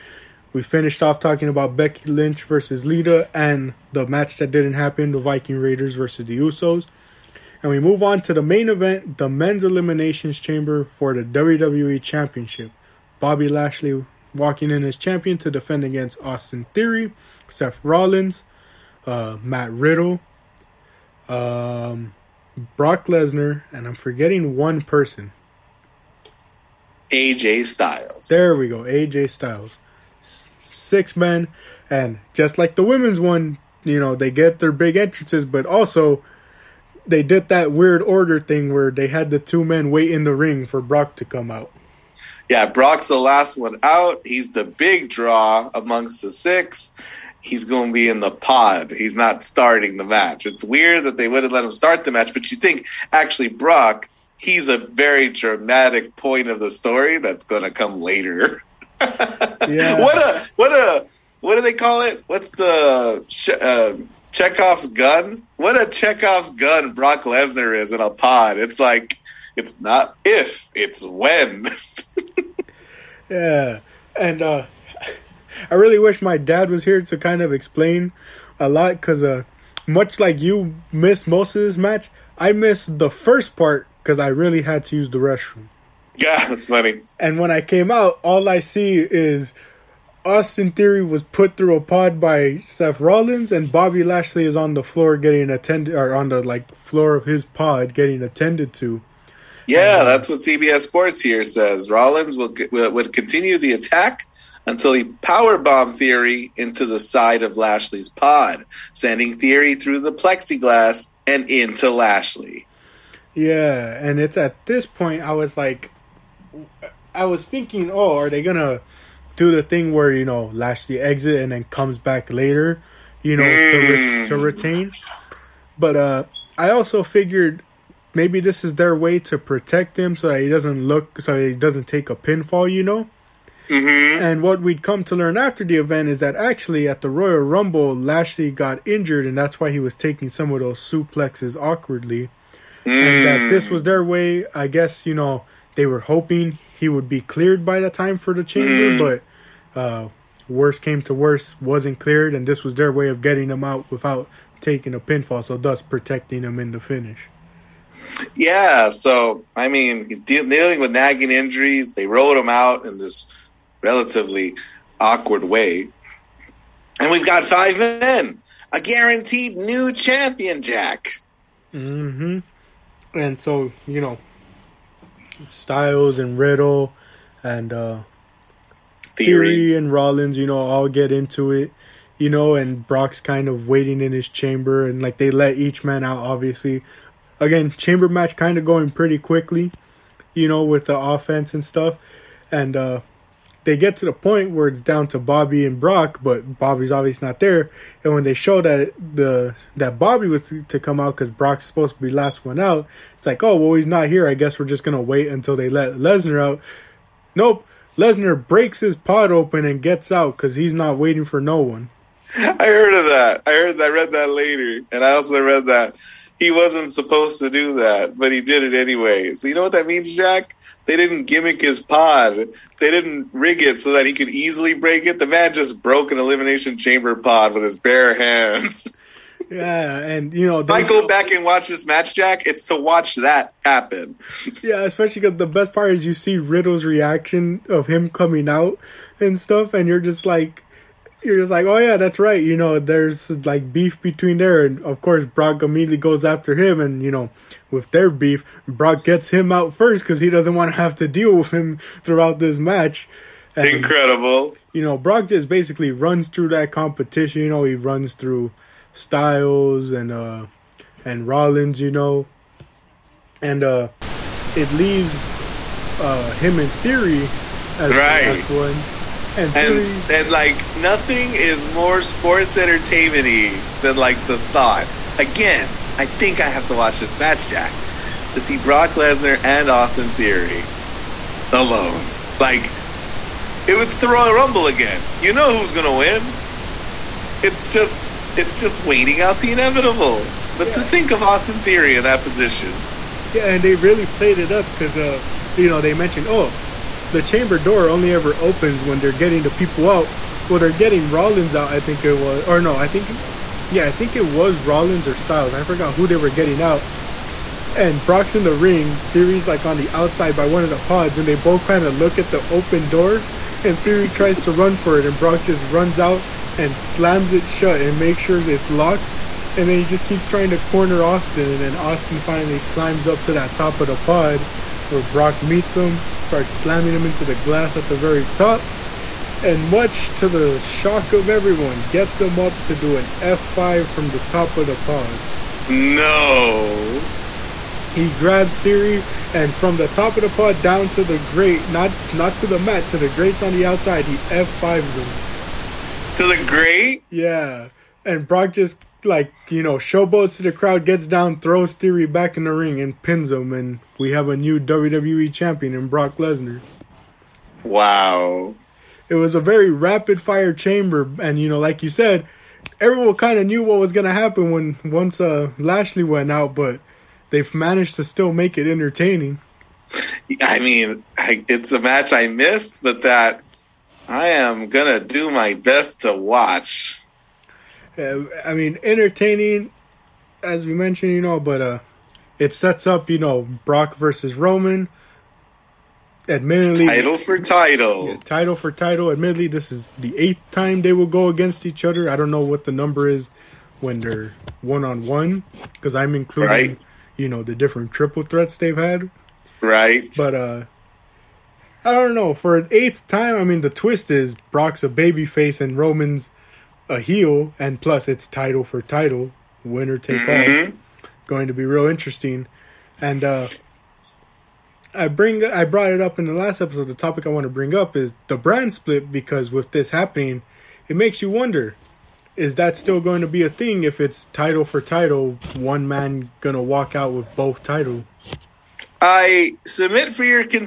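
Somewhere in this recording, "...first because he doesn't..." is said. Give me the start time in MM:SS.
04:09.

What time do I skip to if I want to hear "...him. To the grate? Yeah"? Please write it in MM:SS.
05:44.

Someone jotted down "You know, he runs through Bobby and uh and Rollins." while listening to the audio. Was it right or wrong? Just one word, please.
wrong.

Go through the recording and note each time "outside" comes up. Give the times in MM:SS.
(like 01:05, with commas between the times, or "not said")
05:09, 05:43.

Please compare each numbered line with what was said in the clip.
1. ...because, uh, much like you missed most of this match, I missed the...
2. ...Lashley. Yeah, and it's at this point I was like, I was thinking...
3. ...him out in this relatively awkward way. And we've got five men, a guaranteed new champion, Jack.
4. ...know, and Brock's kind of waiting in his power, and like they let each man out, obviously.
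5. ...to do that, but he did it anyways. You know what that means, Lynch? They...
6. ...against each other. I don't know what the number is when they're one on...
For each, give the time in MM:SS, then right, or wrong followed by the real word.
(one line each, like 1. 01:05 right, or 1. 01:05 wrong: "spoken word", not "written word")
1. 01:18 right
2. 01:51 right
3. 02:42 right
4. 03:02 wrong: "chamber", not "power"
5. 03:37 wrong: "Jack", not "Lynch"
6. 06:31 right.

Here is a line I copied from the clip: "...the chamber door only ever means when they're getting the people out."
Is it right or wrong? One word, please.
wrong.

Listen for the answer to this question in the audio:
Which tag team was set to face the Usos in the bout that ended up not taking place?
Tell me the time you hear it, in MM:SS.
00:05.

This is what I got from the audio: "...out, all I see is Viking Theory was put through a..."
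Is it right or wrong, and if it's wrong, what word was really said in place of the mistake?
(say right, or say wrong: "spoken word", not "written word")
wrong: "Austin", not "Viking".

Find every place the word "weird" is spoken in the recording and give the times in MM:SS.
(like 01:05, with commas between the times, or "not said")
00:37, 00:50.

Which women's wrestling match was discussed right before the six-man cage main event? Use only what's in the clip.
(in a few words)
Becky Lynch versus Lita.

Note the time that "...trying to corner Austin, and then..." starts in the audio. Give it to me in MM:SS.
05:20.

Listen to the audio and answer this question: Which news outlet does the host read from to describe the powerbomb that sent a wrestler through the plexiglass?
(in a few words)
CBS Sports.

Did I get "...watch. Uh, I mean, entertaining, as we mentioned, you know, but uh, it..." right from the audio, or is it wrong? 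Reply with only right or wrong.
right.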